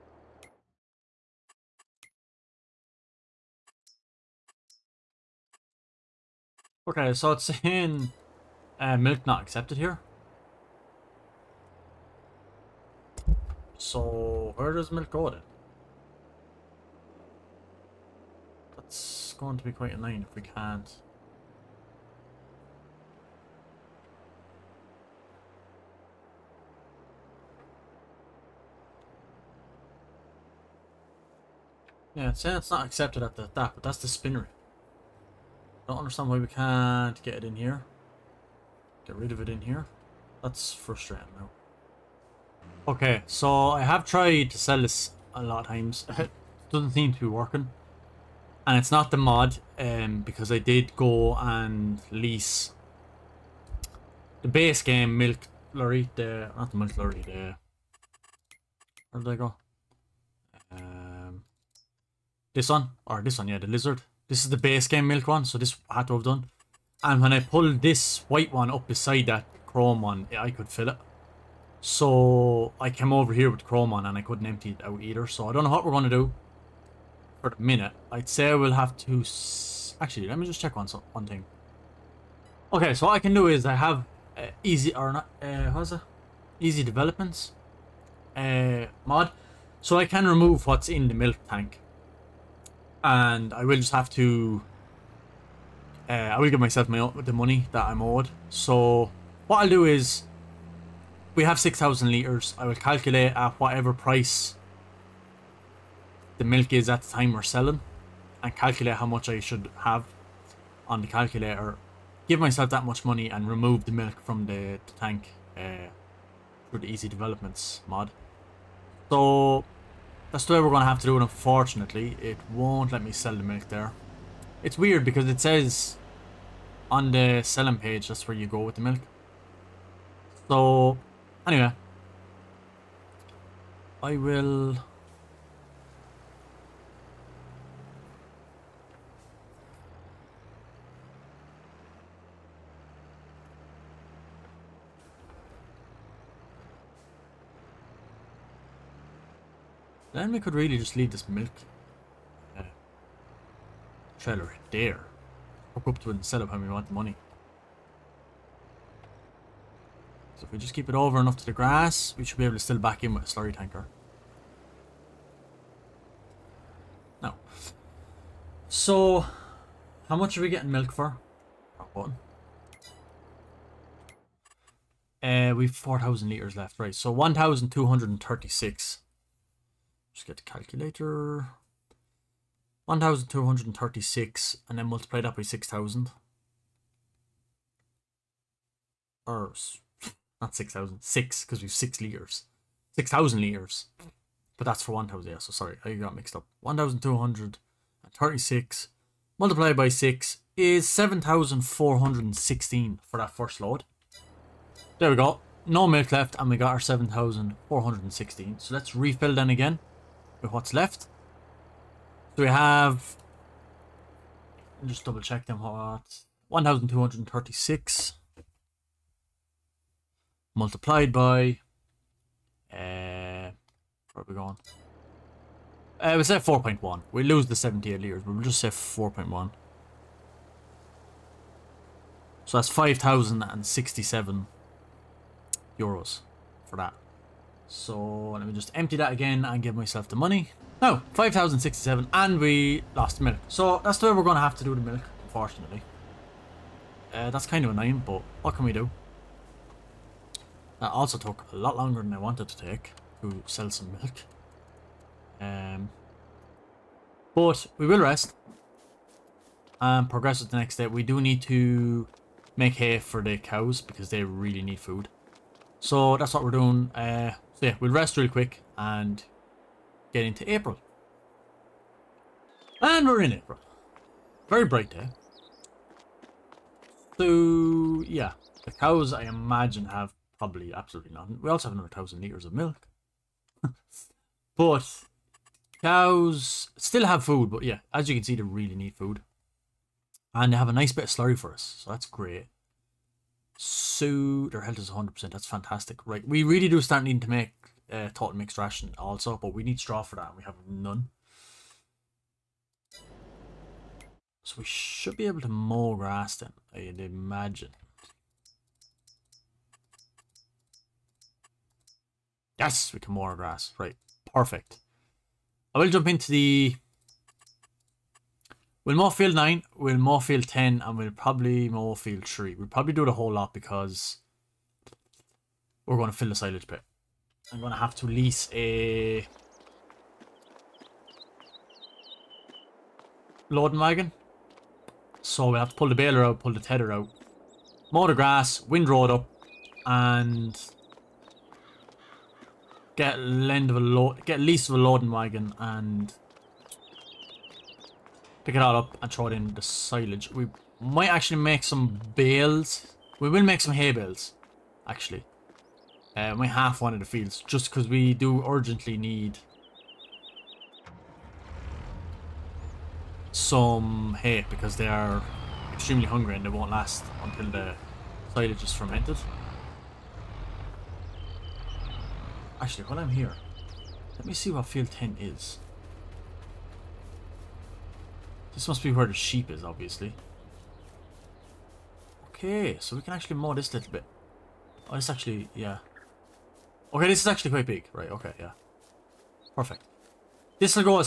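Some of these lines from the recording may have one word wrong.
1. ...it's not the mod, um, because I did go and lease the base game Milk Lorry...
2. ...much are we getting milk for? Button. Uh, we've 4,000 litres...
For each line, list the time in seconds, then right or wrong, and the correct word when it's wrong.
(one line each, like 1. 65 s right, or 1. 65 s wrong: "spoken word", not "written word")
1. 48 s right
2. 170 s right.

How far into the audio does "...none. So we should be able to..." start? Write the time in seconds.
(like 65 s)
300 s.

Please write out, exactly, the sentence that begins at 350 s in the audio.
We might actually make some bales.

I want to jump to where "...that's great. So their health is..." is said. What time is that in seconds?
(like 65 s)
291 s.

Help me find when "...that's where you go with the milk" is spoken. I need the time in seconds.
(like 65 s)
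128 s.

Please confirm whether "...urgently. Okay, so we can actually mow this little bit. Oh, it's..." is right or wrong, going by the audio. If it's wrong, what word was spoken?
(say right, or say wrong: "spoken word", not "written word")
wrong: "obviously", not "urgently".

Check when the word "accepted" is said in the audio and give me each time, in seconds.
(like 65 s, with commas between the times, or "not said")
9 s, 32 s.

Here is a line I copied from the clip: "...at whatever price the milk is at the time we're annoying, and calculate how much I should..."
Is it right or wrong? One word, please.
wrong.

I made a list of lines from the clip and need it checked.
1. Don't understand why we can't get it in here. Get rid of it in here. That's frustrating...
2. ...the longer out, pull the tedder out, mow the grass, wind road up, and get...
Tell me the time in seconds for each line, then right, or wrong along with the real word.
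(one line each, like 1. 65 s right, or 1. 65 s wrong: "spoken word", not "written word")
1. 35 s right
2. 335 s wrong: "baler", not "longer".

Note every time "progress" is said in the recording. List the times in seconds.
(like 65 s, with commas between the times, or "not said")
260 s.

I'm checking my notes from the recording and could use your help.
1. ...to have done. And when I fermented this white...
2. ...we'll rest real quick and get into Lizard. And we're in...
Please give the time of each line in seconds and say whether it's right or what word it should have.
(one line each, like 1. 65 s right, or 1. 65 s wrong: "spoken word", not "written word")
1. 66 s wrong: "pulled", not "fermented"
2. 267 s wrong: "April", not "Lizard".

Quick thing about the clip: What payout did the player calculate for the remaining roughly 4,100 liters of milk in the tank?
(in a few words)
5,067 euros.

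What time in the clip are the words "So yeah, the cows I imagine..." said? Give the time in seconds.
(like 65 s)
277 s.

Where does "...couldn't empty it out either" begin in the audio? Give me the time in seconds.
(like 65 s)
74 s.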